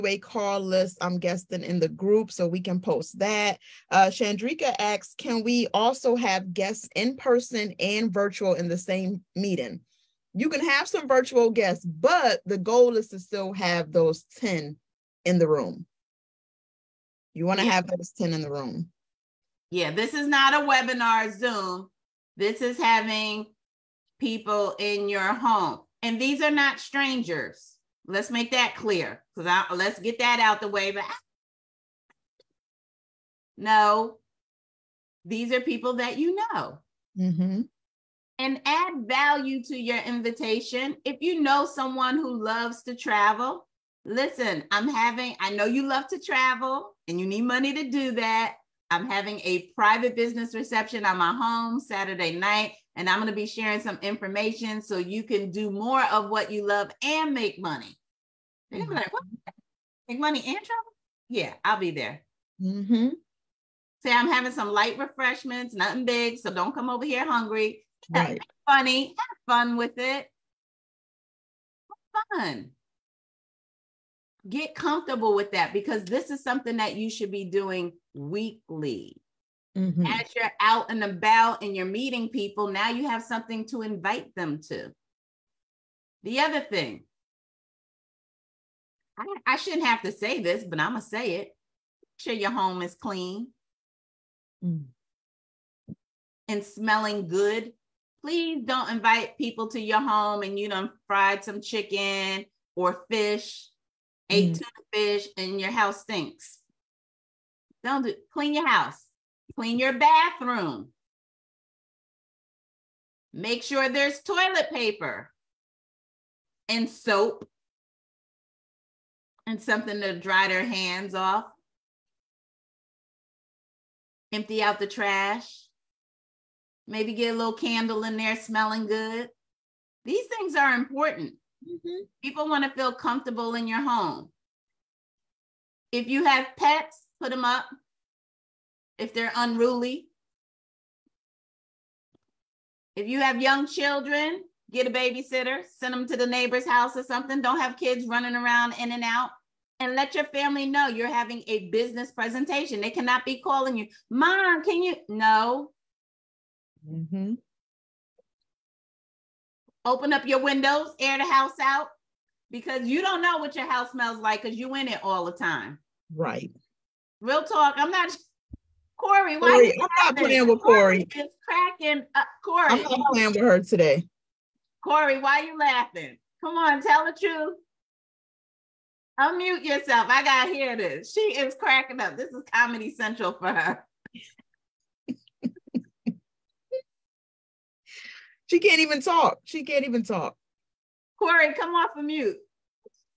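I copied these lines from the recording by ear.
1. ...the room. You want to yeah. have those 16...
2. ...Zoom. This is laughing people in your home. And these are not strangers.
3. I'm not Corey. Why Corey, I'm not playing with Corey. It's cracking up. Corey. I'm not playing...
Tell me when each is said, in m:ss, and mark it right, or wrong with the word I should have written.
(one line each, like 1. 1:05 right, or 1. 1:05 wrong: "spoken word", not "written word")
1. 0:15 wrong: "10", not "16"
2. 0:21 wrong: "having", not "laughing"
3. 2:47 right.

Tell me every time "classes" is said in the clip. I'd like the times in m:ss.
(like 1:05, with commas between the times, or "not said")
not said.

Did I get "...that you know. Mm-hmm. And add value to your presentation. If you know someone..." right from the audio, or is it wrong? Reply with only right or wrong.
wrong.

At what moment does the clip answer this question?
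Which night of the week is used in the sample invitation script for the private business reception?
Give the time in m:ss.
0:51.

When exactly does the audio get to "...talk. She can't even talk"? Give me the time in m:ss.
3:09.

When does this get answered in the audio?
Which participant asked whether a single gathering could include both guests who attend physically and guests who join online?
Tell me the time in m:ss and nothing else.
0:04.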